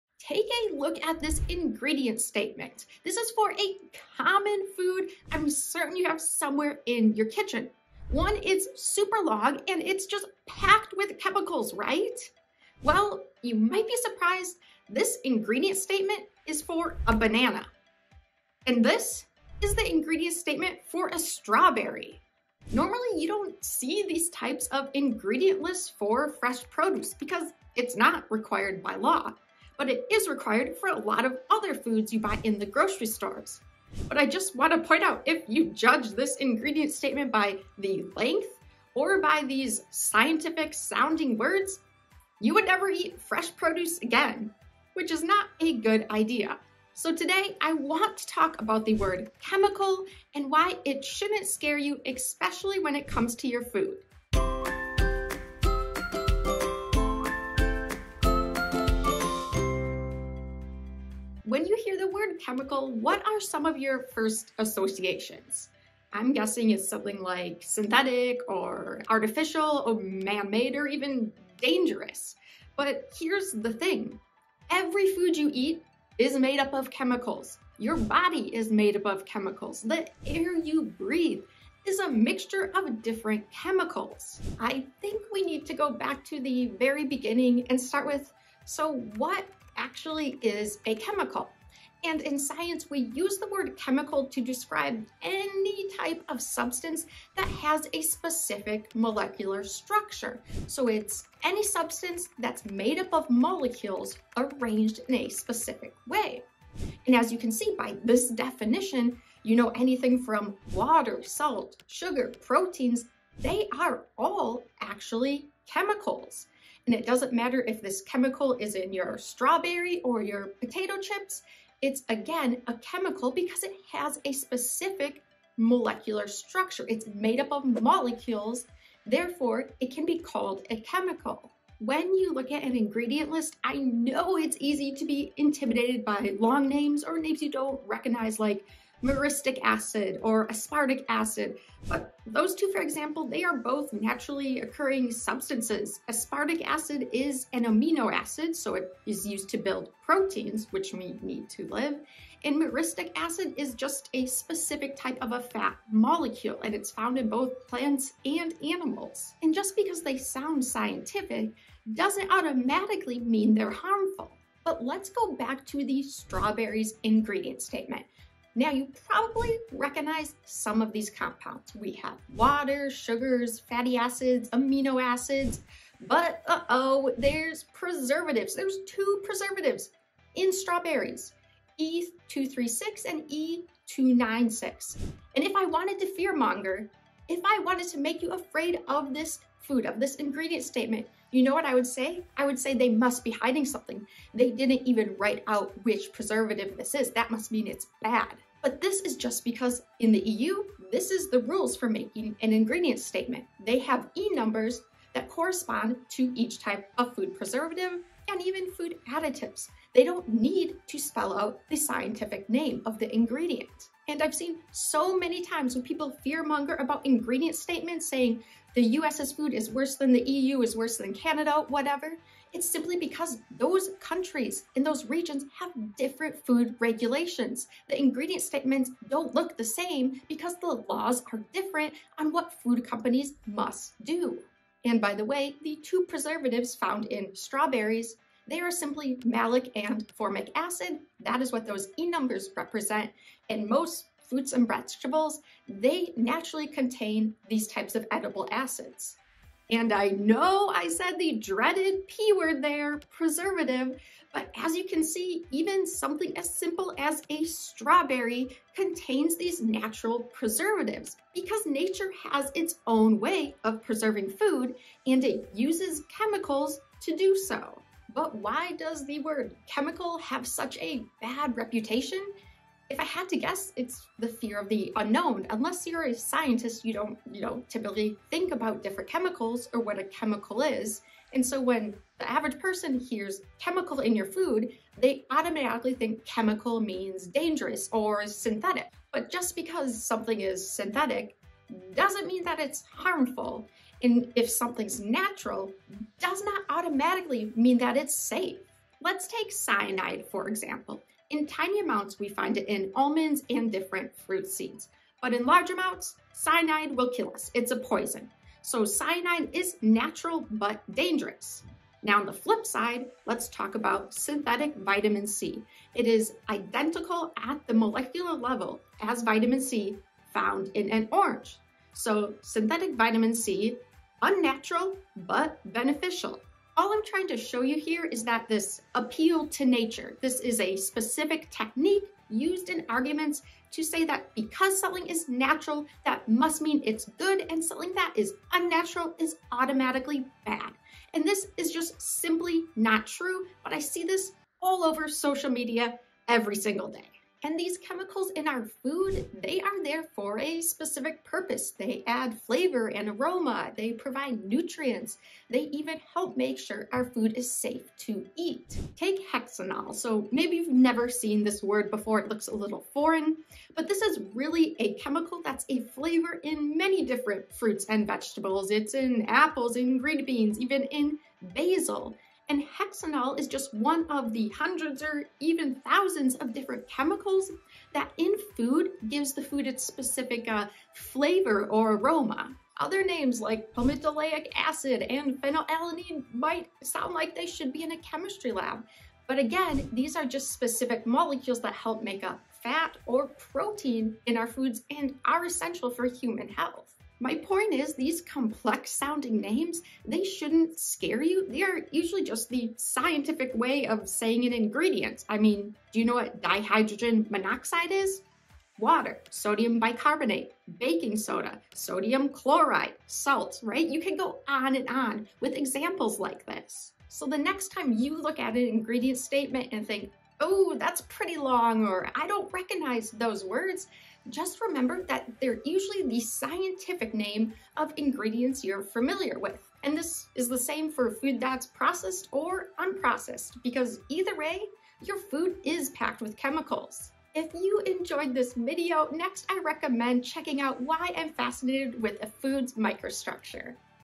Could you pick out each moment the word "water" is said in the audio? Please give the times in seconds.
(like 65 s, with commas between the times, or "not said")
110 s, 172 s, 408 s.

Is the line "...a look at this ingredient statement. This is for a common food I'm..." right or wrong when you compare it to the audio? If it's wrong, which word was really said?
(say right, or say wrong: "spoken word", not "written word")
right.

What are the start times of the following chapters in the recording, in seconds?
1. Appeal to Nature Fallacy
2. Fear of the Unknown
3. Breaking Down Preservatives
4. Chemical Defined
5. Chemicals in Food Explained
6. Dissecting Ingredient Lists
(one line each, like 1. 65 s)
1. 326 s
2. 270 s
3. 250 s
4. 88 s
5. 350 s
6. 144 s.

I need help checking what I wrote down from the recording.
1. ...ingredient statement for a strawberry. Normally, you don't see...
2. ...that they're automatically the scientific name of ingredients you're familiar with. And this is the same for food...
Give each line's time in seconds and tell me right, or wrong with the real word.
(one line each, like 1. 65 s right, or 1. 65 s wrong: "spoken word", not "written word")
1. 19 s right
2. 425 s wrong: "usually", not "automatically".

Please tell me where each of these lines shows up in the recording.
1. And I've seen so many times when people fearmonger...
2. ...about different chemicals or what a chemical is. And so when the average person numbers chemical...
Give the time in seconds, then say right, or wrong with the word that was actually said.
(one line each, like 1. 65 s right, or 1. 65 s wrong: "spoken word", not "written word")
1. 214 s right
2. 278 s wrong: "hears", not "numbers".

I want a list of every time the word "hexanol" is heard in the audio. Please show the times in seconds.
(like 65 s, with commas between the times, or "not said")
359 s, 372 s.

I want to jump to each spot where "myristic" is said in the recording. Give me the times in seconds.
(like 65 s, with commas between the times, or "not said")
139 s, 152 s.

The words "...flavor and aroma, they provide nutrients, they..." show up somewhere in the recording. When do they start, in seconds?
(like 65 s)
352 s.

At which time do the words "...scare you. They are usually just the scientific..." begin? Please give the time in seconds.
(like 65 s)
400 s.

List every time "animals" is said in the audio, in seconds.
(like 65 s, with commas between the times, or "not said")
158 s.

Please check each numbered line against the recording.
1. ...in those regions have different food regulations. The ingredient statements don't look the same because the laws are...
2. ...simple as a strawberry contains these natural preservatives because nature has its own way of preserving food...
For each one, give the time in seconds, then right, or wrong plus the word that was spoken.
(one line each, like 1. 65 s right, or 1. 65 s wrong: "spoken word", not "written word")
1. 224 s right
2. 256 s right.